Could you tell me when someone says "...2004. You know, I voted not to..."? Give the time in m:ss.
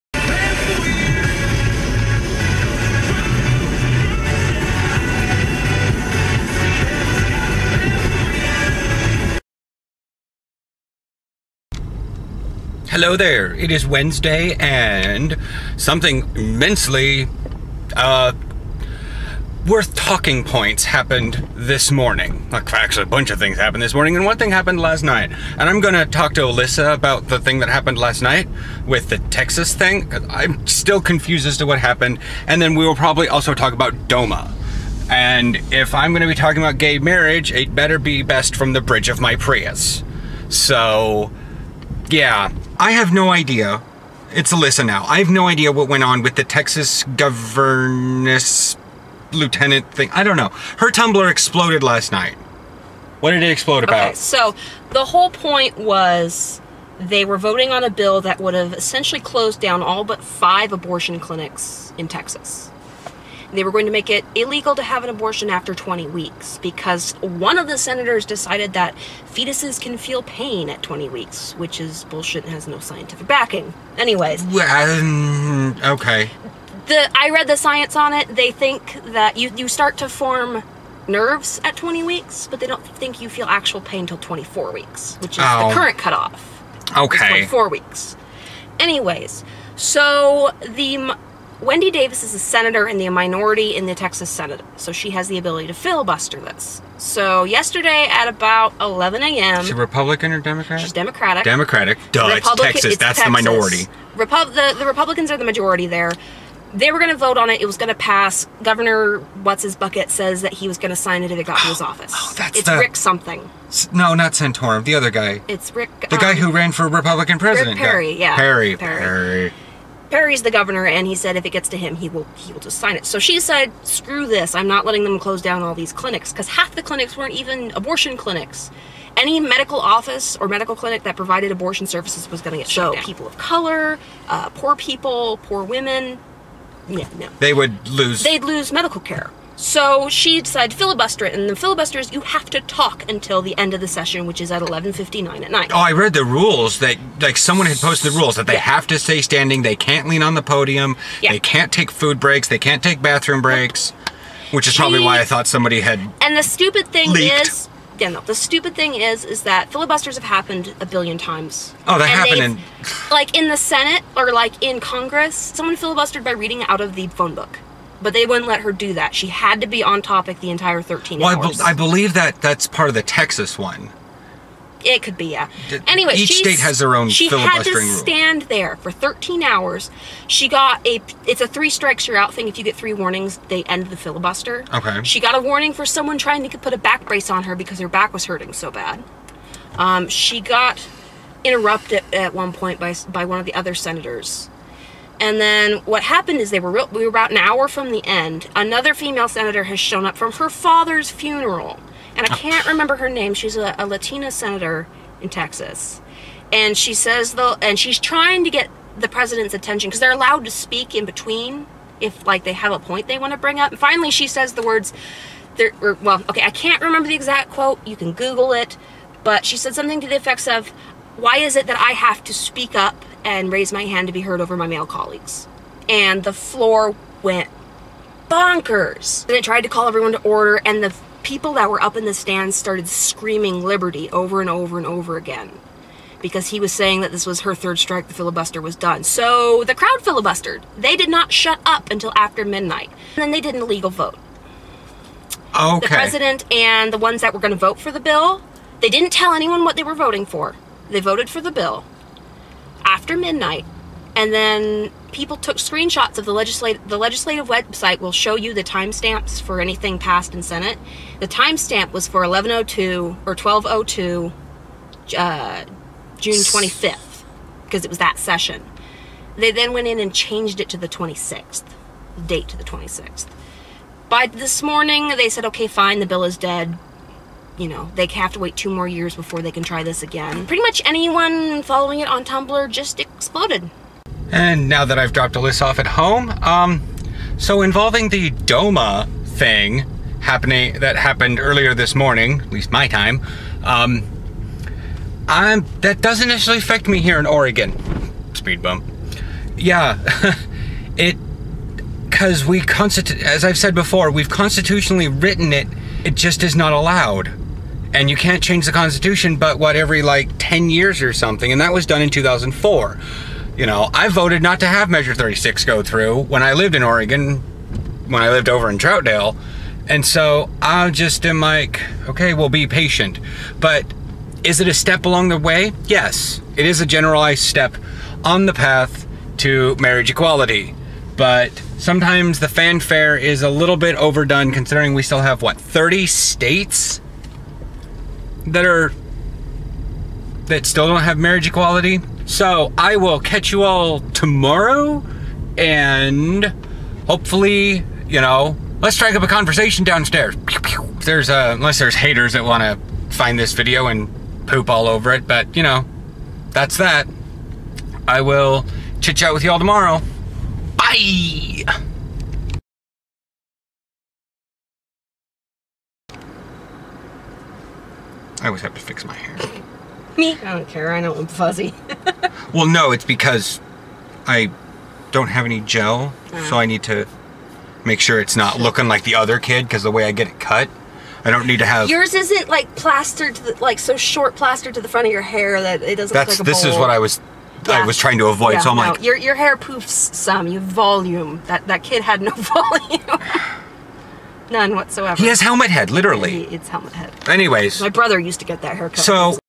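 5:12.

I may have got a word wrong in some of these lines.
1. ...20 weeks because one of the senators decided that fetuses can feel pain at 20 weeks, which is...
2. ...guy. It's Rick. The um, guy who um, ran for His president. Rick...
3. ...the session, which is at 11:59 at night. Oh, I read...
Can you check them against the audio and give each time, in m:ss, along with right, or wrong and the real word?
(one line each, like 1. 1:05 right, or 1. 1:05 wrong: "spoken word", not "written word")
1. 1:05 right
2. 1:55 wrong: "Republican", not "His"
3. 2:23 right.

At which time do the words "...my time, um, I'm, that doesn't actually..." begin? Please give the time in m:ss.
4:52.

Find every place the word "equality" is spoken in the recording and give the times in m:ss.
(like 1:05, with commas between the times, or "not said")
5:30, 5:41.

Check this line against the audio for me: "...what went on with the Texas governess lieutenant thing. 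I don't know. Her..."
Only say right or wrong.
right.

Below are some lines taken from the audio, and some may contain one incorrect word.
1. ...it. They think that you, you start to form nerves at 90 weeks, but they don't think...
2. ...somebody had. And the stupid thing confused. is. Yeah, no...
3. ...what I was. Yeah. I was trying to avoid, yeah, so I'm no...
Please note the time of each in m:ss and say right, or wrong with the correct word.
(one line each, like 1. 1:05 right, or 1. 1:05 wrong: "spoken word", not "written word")
1. 1:18 wrong: "20", not "90"
2. 2:35 wrong: "leaked", not "confused"
3. 6:26 right.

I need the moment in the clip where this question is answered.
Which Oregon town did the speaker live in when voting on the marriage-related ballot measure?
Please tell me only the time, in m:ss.
5:18.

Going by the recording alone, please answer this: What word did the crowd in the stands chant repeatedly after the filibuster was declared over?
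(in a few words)
Liberty.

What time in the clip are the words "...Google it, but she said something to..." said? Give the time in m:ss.
3:38.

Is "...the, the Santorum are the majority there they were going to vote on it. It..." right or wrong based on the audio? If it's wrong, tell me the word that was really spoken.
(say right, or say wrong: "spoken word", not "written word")
wrong: "Republicans", not "Santorum".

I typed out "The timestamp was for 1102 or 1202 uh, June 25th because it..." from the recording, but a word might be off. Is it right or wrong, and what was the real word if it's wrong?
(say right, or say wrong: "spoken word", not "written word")
right.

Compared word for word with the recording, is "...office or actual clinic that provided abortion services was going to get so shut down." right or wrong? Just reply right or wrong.
wrong.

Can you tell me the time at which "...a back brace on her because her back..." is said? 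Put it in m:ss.
3:06.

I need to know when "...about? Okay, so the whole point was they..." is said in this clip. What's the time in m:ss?
0:53.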